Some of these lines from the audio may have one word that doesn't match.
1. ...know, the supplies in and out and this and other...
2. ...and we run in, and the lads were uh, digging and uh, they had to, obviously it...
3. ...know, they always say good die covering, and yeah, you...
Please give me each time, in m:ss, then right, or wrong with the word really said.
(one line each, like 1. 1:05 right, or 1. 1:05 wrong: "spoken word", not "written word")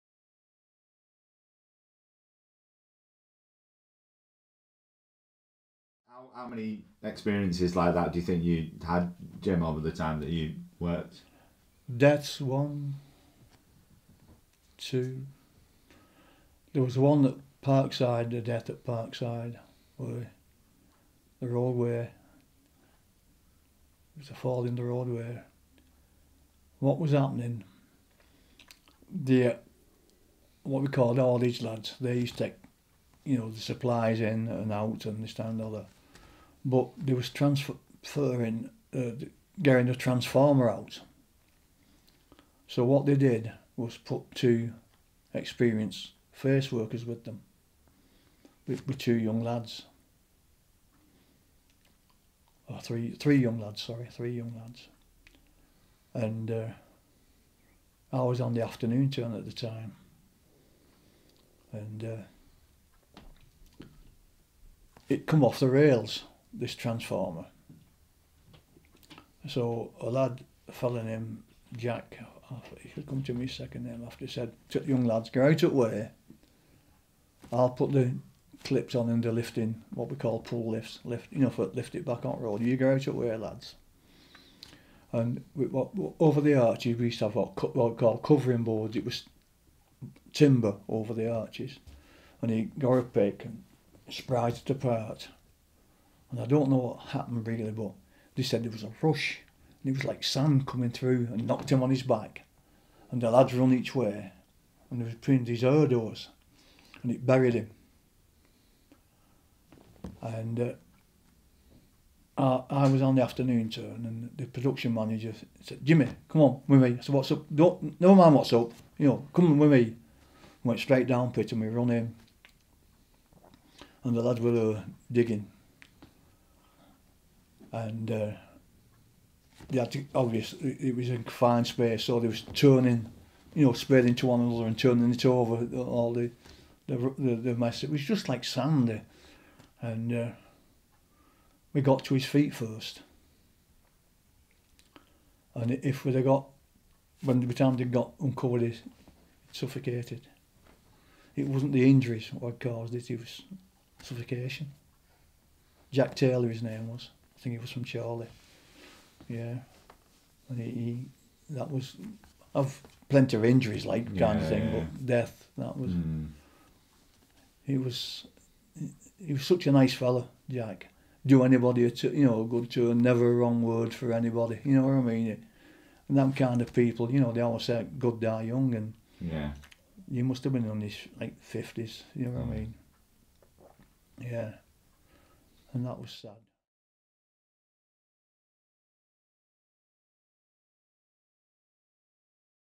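1. 0:33 right
2. 2:01 right
3. 2:57 wrong: "young", not "covering".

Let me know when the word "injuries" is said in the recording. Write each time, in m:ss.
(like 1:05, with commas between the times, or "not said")
2:31, 2:43.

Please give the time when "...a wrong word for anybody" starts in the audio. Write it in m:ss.
2:53.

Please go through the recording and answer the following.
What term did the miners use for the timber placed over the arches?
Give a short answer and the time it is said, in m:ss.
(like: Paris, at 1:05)
covering boards, at 1:28.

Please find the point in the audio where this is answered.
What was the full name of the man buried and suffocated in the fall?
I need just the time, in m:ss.
2:35.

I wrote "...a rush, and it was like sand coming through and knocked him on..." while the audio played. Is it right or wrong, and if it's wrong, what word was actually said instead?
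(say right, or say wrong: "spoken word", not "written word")
right.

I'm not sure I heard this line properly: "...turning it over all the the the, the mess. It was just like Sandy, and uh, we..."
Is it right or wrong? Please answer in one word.
right.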